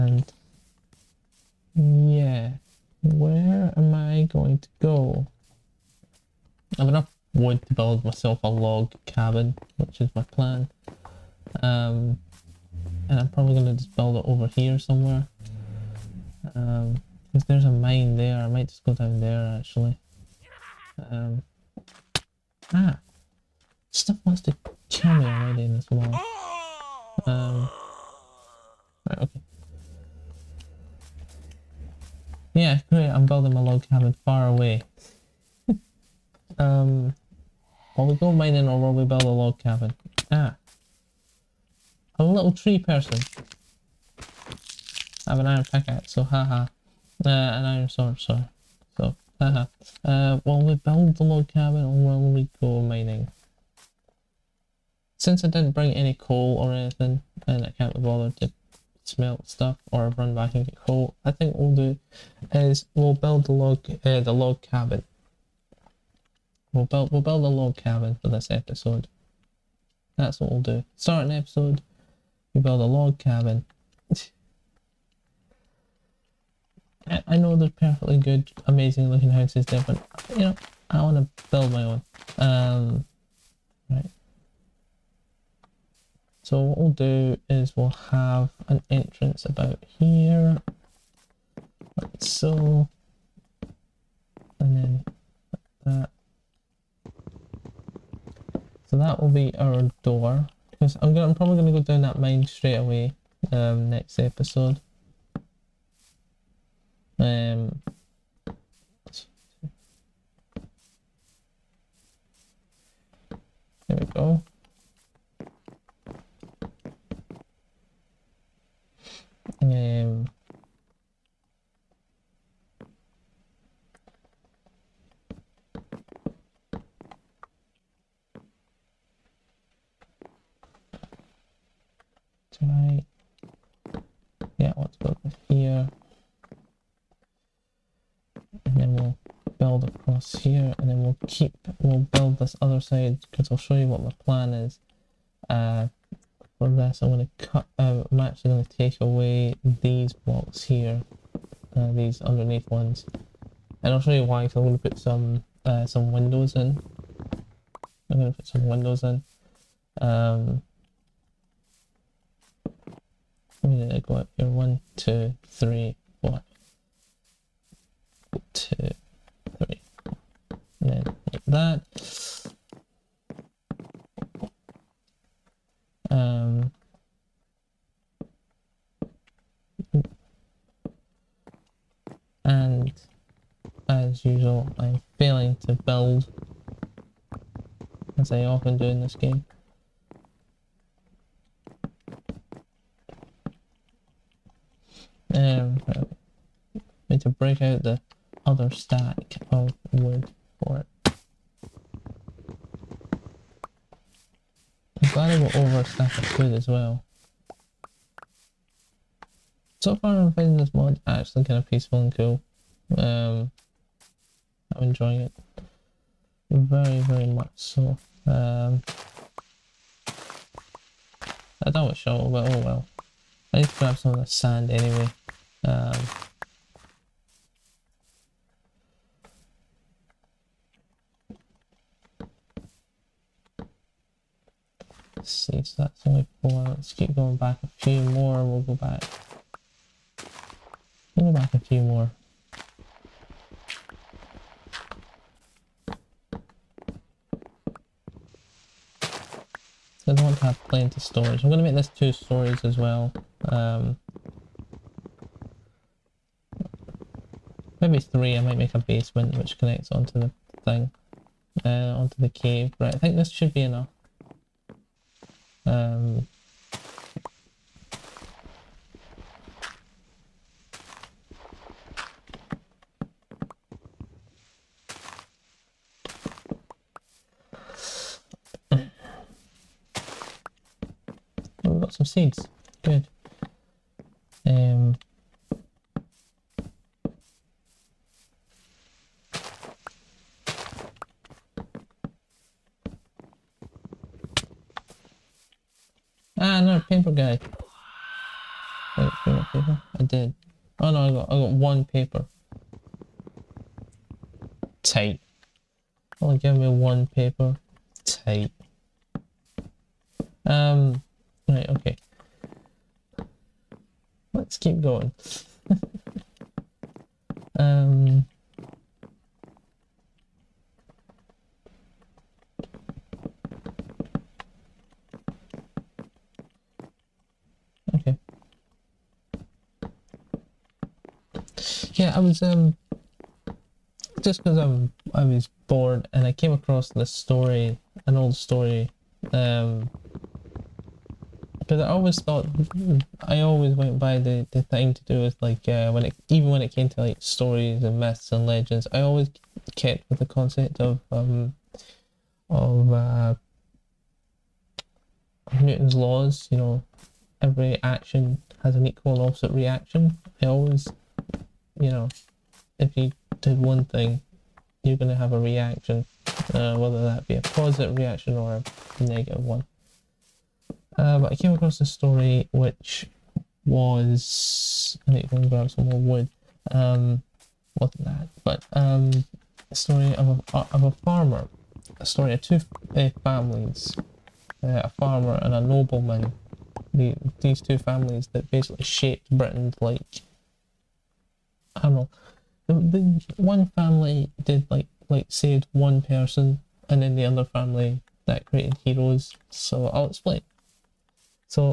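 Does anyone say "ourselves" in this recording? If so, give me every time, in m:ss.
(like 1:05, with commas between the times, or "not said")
not said.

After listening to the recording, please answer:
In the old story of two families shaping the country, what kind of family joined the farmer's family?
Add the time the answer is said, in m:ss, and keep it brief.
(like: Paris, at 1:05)
a nobleman, at 6:25.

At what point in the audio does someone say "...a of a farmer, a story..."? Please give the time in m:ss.
6:20.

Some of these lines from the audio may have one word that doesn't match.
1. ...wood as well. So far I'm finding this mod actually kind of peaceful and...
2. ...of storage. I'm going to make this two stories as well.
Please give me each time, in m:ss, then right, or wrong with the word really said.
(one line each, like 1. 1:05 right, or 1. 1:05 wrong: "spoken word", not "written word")
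1. 3:26 right
2. 4:10 right.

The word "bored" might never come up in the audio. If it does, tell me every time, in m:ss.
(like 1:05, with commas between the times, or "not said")
5:35.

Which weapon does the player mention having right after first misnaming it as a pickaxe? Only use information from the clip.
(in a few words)
iron sword.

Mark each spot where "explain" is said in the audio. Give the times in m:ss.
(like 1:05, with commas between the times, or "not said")
6:40.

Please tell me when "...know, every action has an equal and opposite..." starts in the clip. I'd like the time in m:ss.
5:56.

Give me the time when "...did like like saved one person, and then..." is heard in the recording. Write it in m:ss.
6:34.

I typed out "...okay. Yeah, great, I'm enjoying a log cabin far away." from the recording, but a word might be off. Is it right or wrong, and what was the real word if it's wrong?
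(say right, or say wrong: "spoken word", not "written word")
wrong: "building", not "enjoying".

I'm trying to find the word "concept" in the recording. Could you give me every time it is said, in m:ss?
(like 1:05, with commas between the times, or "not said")
5:50.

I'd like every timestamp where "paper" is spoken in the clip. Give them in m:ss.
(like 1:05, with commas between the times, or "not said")
5:01, 5:07.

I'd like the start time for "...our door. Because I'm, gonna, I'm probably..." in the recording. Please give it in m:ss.
1:39.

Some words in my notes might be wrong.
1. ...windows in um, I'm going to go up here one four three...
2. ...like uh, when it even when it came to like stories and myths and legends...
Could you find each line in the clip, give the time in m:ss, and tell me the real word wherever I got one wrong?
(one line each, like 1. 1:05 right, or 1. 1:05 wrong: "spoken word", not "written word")
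1. 2:38 wrong: "two", not "four"
2. 5:45 right.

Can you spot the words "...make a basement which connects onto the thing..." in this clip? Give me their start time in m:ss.
4:18.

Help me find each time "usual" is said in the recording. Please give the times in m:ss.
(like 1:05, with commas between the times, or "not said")
3:04.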